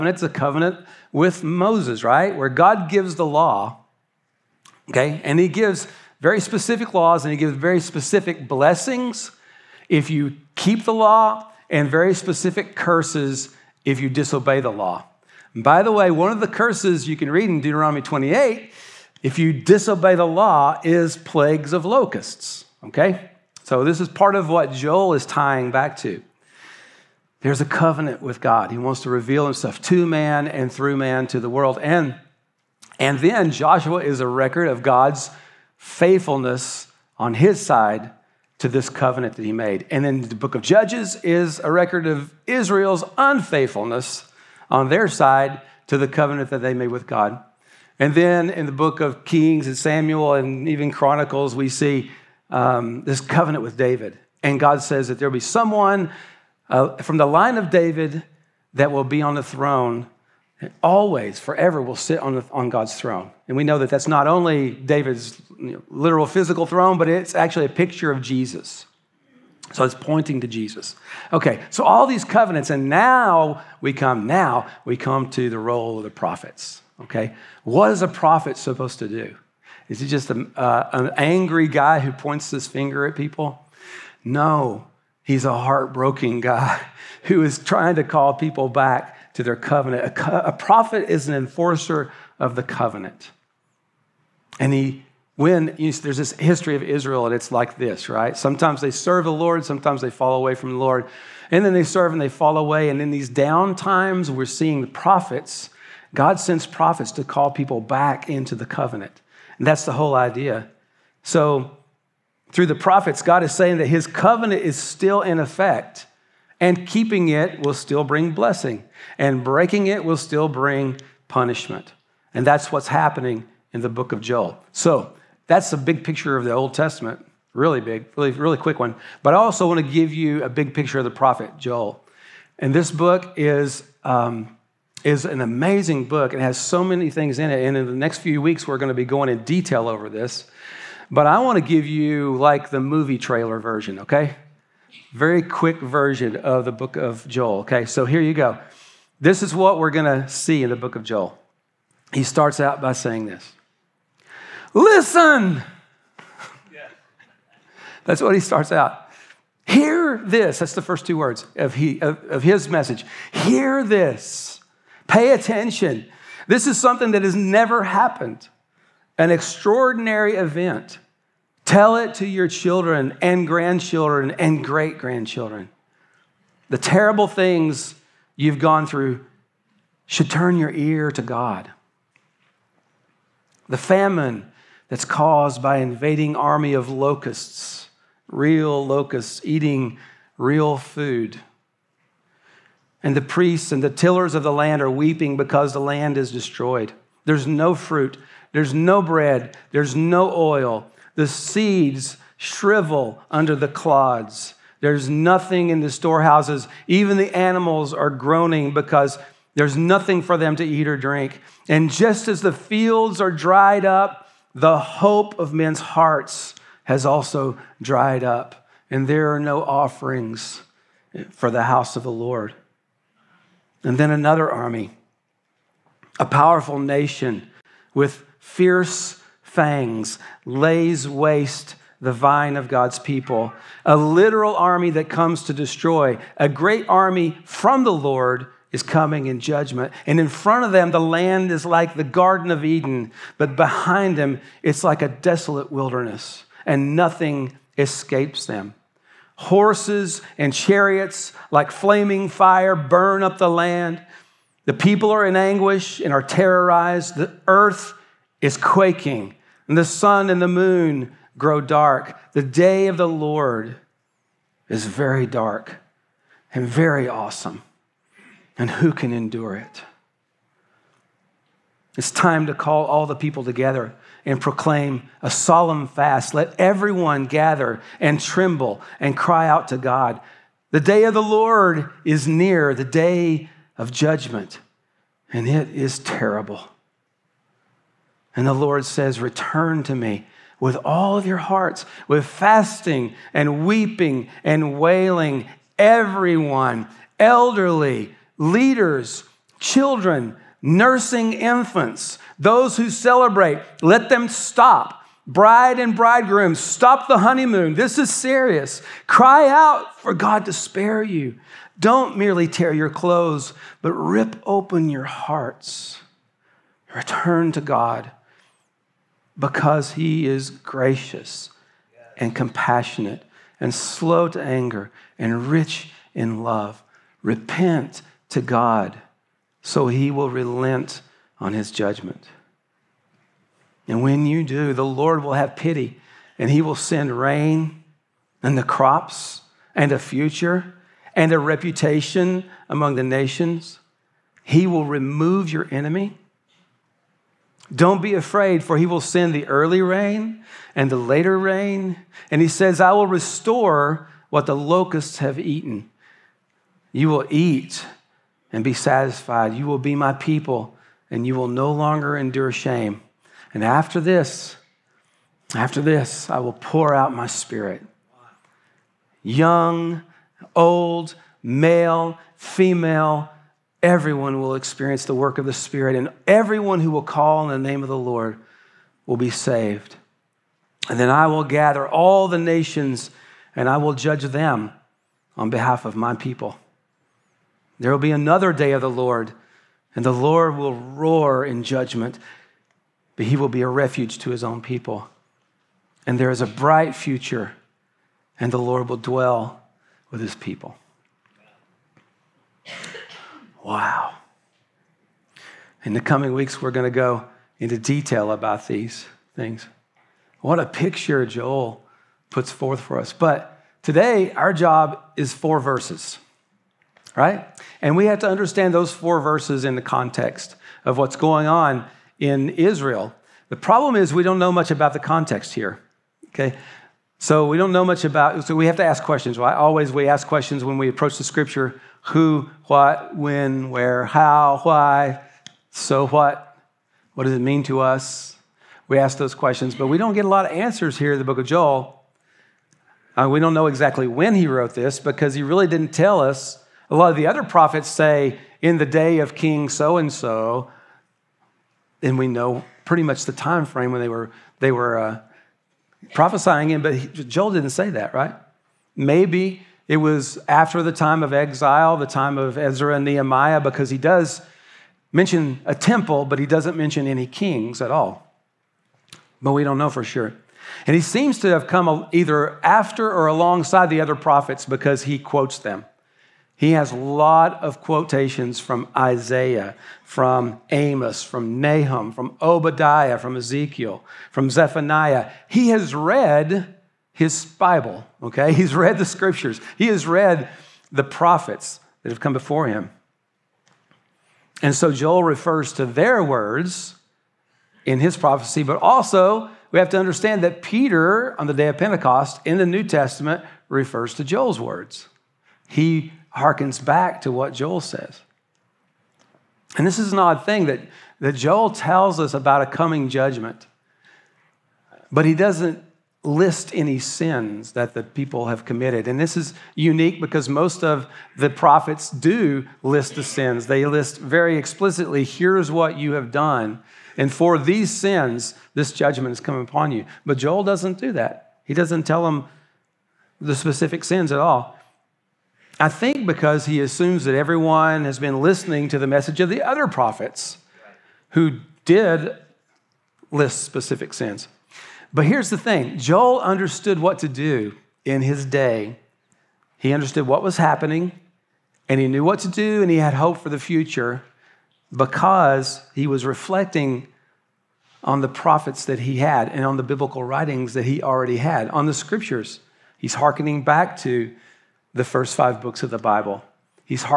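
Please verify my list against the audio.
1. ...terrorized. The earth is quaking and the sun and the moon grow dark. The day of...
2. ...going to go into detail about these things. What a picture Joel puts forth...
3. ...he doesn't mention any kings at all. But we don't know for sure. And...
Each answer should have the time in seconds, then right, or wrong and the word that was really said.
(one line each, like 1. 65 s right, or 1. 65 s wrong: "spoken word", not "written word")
1. 256 s right
2. 406 s right
3. 466 s right.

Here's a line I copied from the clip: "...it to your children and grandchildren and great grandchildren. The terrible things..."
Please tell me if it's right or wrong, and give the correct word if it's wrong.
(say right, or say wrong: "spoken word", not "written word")
right.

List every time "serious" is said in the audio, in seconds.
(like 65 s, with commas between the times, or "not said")
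308 s.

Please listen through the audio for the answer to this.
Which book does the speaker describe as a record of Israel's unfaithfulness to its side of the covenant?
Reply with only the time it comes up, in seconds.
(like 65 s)
40 s.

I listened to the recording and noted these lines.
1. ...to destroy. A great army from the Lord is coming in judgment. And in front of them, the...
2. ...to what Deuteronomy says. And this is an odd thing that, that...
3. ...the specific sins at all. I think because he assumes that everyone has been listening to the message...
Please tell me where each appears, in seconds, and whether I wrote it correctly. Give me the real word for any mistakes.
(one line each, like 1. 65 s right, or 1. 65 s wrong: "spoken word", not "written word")
1. 235 s right
2. 507 s wrong: "Joel", not "Deuteronomy"
3. 533 s right.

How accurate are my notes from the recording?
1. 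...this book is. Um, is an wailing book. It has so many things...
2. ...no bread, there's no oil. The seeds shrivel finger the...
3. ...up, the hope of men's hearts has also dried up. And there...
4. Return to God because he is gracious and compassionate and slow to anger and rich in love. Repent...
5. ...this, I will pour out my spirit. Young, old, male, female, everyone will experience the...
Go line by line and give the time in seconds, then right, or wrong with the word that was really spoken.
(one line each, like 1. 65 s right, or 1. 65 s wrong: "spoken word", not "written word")
1. 132 s wrong: "amazing", not "wailing"
2. 198 s wrong: "under", not "finger"
3. 213 s right
4. 316 s right
5. 365 s right.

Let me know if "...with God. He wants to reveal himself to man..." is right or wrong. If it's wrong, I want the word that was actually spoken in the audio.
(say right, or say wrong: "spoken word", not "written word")
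right.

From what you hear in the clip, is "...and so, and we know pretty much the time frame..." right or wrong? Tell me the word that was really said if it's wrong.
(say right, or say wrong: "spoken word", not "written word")
right.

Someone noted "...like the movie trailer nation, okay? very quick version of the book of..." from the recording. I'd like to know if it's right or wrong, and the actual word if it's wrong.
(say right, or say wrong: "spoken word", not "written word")
wrong: "version", not "nation".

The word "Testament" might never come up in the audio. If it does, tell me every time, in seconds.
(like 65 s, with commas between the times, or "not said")
126 s, 502 s.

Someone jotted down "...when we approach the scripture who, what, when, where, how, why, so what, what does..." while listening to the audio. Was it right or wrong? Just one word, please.
right.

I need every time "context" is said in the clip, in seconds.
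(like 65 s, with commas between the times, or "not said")
419 s, 424 s.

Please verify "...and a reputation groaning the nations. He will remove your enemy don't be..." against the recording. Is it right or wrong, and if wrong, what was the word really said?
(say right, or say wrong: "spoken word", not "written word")
wrong: "among", not "groaning".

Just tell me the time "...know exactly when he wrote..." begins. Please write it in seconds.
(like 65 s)
443 s.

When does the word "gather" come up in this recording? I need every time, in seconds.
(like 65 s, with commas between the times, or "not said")
277 s, 381 s.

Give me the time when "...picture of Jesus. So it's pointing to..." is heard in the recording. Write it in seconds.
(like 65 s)
67 s.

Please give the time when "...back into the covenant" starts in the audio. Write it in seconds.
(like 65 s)
107 s.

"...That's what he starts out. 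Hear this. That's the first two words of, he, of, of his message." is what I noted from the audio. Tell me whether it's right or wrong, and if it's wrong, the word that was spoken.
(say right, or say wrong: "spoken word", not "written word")
right.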